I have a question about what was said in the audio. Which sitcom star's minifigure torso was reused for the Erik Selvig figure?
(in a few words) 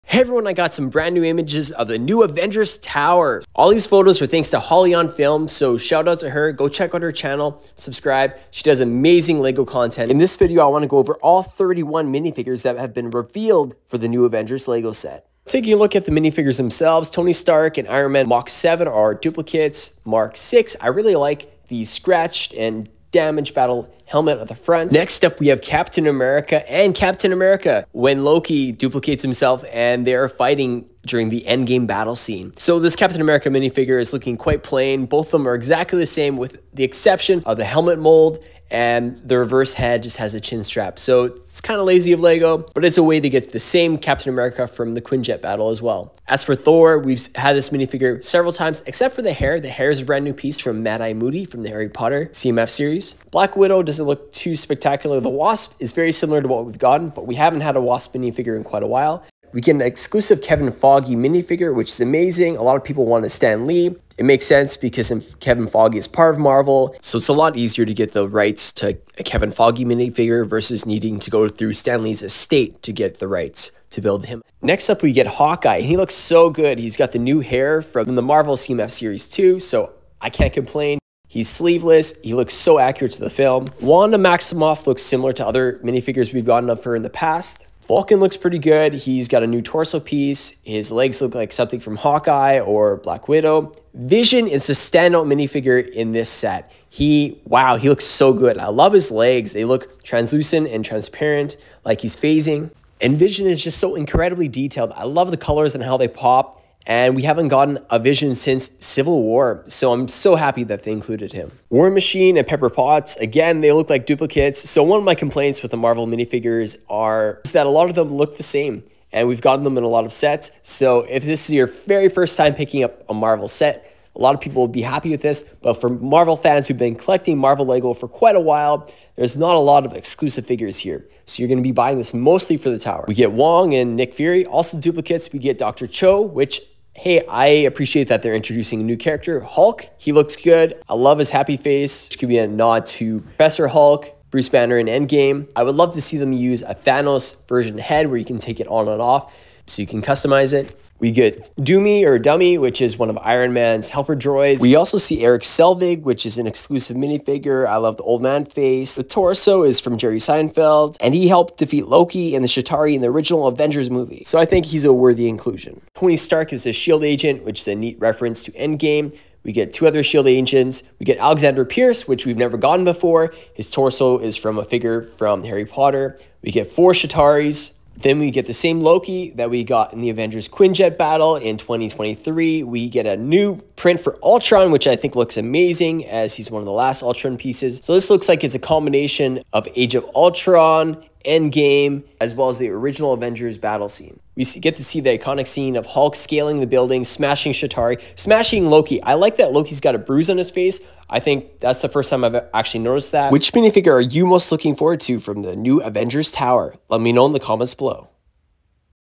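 Jerry Seinfeld.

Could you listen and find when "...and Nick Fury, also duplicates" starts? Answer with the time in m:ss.
2:13.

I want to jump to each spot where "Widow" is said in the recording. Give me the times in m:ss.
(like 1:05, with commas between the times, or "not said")
0:53, 1:33.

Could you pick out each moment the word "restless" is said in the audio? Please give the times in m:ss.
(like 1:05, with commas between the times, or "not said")
not said.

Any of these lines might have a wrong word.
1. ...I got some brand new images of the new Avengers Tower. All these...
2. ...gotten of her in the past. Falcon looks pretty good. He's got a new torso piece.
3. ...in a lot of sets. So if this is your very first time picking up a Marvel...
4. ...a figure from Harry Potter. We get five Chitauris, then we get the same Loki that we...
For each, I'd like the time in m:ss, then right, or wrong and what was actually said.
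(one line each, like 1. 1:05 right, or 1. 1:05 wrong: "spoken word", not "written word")
1. 0:00 right
2. 1:26 right
3. 1:59 right
4. 2:54 wrong: "four", not "five".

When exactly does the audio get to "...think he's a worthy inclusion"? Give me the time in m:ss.
2:44.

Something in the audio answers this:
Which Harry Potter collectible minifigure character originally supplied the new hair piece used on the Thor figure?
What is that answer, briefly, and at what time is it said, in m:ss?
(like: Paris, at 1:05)
Mad Eye Moody, at 0:50.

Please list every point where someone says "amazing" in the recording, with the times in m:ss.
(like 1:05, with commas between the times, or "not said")
0:08, 1:01, 3:05.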